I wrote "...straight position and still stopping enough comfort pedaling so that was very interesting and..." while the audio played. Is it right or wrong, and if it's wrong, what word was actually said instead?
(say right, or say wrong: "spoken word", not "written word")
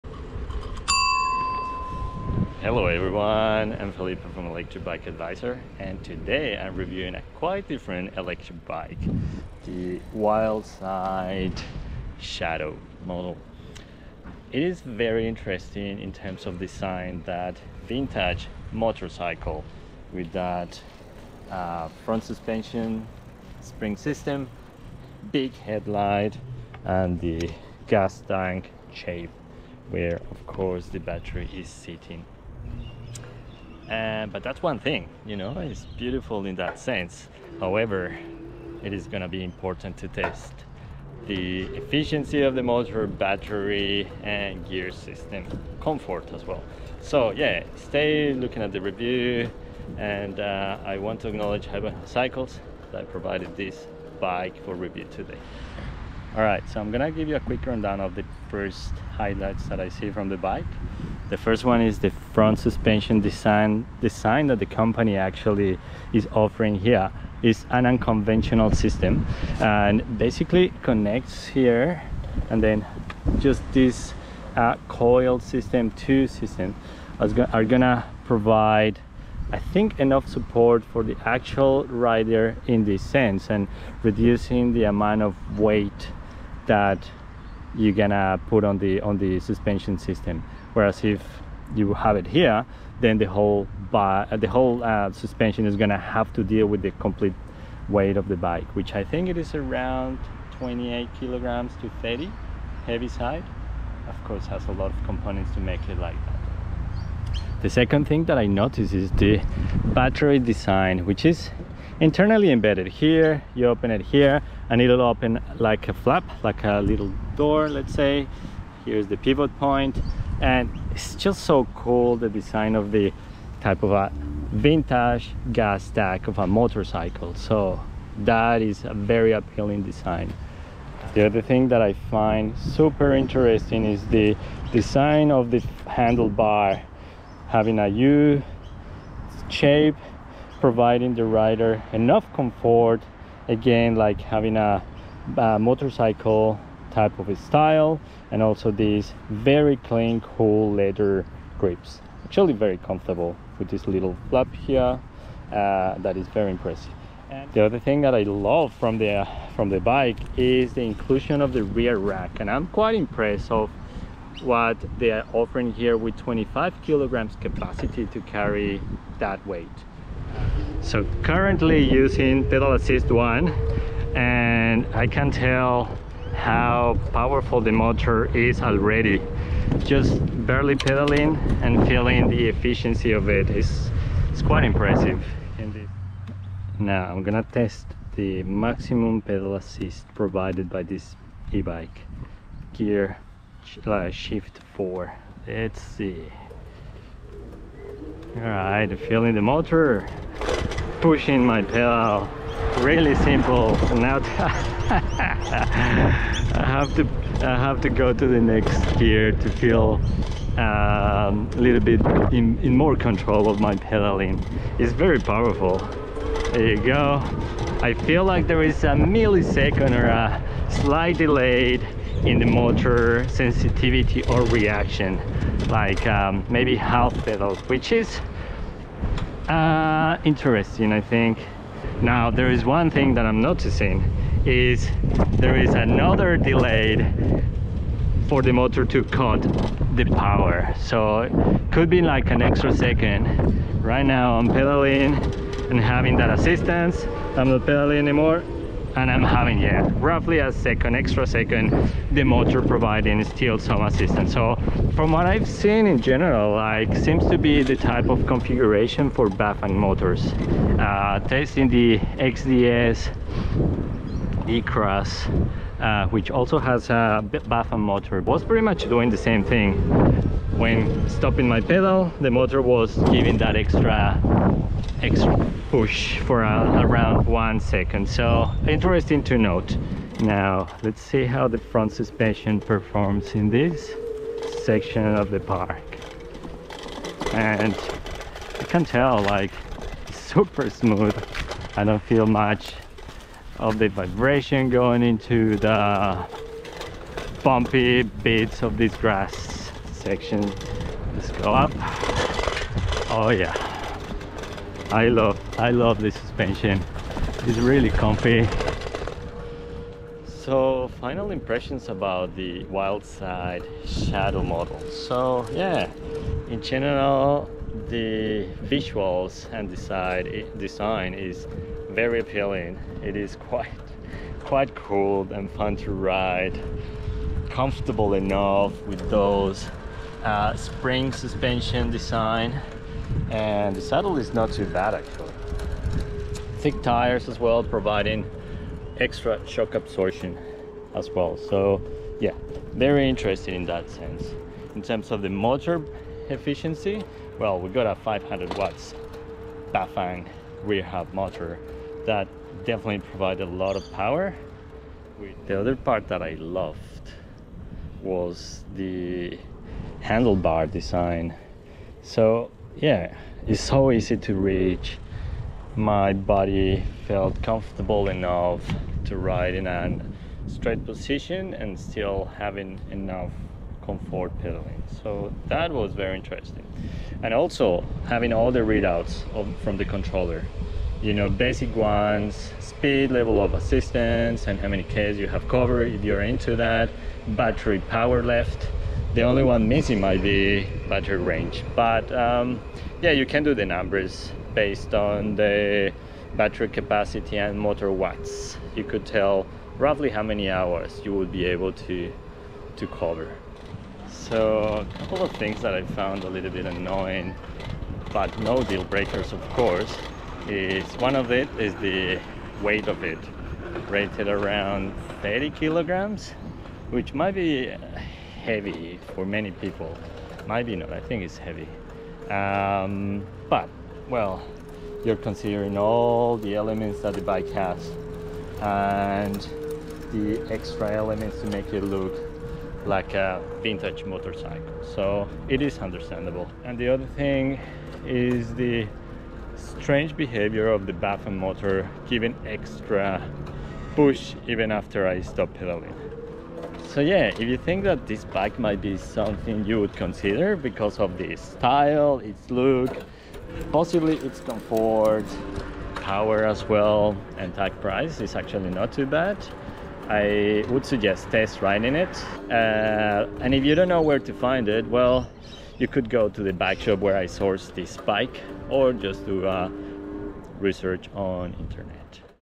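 wrong: "having", not "stopping".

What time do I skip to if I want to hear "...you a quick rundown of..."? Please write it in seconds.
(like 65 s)
57 s.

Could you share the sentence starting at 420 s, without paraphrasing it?
Maybe not, I think it's heavy.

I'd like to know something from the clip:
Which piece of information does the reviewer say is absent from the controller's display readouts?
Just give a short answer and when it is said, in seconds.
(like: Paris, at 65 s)
battery range, at 390 s.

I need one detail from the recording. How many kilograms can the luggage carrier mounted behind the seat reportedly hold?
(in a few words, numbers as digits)
25 kilograms.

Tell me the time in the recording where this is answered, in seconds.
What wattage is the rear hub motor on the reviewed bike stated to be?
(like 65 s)
347 s.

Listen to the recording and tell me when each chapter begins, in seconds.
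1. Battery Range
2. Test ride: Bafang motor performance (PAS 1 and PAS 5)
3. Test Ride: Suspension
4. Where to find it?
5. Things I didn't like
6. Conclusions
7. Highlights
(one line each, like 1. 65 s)
1. 391 s
2. 170 s
3. 280 s
4. 462 s
5. 404 s
6. 309 s
7. 56 s.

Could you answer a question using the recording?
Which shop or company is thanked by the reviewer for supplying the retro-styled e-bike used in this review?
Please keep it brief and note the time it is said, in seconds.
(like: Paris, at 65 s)
Heaven Cycles, at 51 s.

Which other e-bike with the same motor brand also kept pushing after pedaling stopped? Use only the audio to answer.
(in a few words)
XDS E-Cross.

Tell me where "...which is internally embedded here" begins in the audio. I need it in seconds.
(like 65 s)
111 s.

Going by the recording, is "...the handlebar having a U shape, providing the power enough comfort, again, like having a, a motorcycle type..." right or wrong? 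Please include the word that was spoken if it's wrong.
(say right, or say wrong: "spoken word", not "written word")
wrong: "rider", not "power".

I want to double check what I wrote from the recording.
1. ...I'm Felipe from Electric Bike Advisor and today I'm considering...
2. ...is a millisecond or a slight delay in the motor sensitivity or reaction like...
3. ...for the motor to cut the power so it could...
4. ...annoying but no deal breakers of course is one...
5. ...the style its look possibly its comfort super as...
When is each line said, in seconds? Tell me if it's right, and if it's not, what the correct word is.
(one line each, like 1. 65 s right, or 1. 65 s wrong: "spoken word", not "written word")
1. 3 s wrong: "reviewing", not "considering"
2. 218 s right
3. 238 s right
4. 406 s right
5. 451 s wrong: "power", not "super".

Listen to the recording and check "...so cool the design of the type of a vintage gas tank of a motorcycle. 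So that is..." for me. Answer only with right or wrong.
right.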